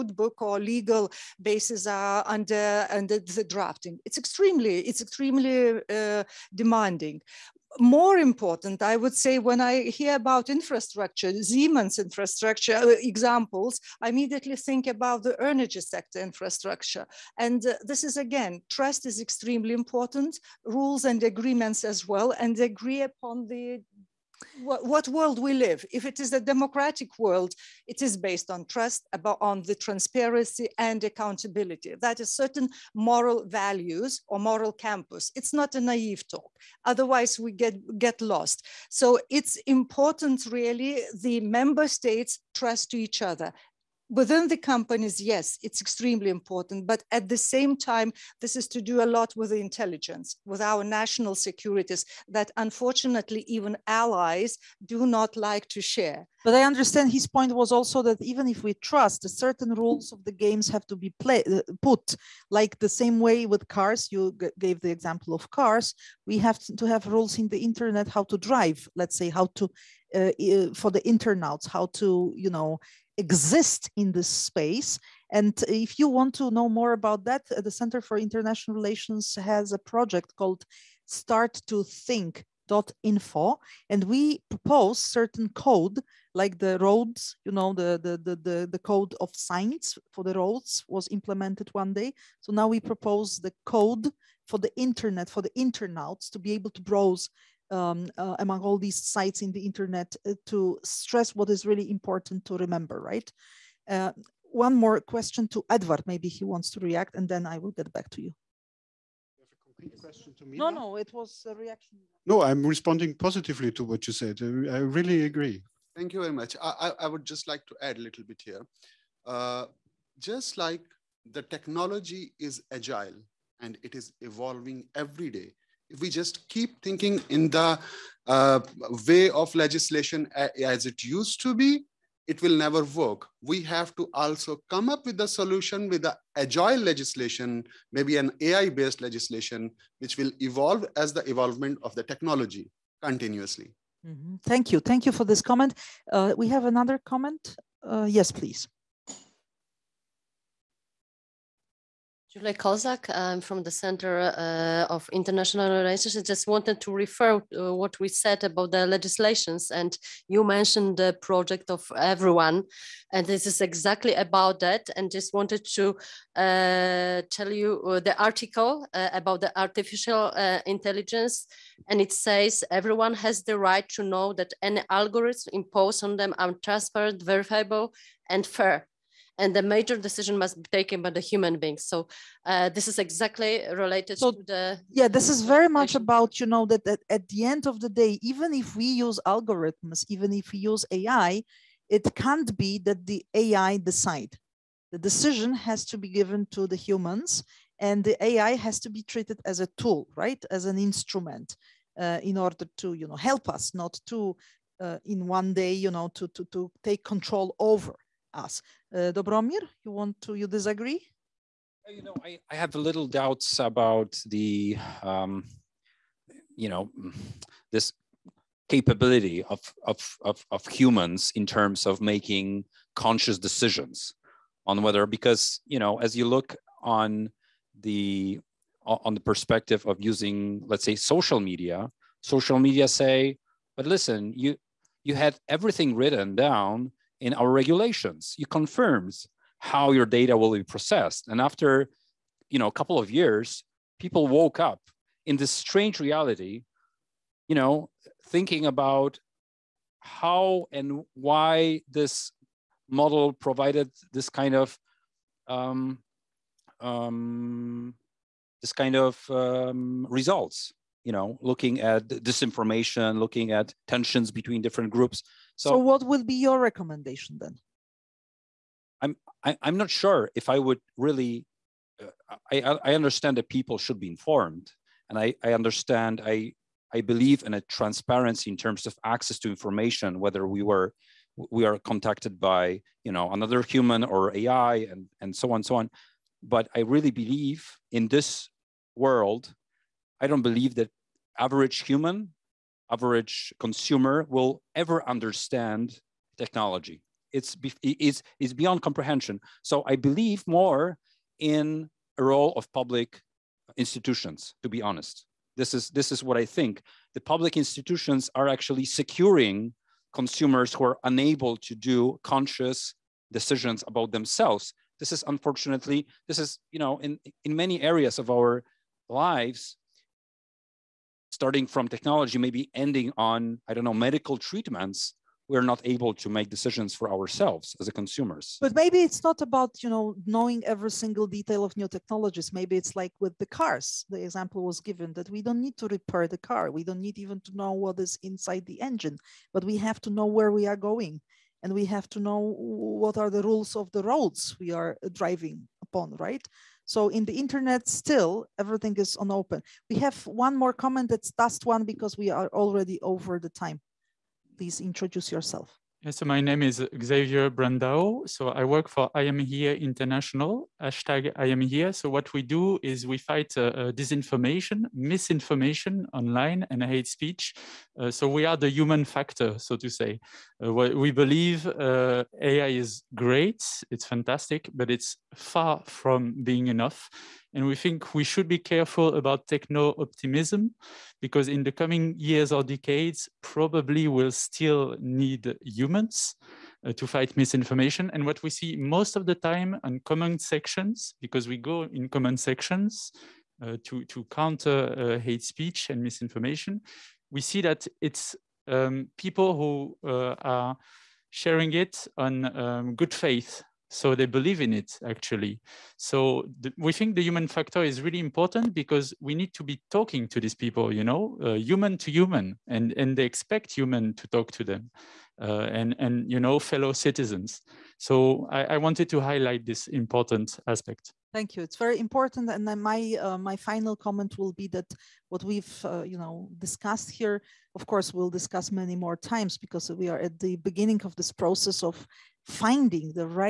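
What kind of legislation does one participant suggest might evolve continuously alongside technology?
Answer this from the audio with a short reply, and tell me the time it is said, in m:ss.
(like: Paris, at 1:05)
AI-based legislation, at 2:18.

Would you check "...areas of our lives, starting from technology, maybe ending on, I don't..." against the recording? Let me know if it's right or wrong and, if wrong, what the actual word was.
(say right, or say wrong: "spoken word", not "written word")
right.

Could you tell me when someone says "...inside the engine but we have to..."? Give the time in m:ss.
5:38.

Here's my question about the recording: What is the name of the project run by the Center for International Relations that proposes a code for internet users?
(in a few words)
Start to Think info.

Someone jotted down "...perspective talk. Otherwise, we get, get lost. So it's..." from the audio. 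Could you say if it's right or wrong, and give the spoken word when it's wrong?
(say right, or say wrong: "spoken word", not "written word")
wrong: "naive", not "perspective".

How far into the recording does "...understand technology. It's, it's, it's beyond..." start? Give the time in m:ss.
4:55.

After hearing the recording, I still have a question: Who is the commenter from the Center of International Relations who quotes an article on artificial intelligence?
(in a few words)
Julie Kozak.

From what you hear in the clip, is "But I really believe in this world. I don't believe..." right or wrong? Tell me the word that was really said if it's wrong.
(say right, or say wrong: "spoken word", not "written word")
right.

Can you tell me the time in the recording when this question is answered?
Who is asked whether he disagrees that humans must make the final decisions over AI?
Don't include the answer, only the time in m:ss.
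3:29.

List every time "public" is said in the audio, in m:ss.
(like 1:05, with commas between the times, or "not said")
5:02, 5:07.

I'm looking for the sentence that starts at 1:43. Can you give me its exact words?
Uh, one more question to Edward, maybe he wants to react and then I will get back to you.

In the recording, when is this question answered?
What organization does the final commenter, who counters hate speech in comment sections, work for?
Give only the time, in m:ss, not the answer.
5:59.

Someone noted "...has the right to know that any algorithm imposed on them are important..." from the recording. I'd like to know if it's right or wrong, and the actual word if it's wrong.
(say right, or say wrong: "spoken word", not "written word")
wrong: "transparent", not "important".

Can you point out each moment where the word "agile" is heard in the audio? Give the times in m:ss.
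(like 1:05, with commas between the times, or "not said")
2:02, 2:16.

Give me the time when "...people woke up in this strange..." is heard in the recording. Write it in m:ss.
4:03.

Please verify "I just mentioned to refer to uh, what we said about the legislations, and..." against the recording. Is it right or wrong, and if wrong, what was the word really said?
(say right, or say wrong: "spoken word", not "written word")
wrong: "wanted", not "mentioned".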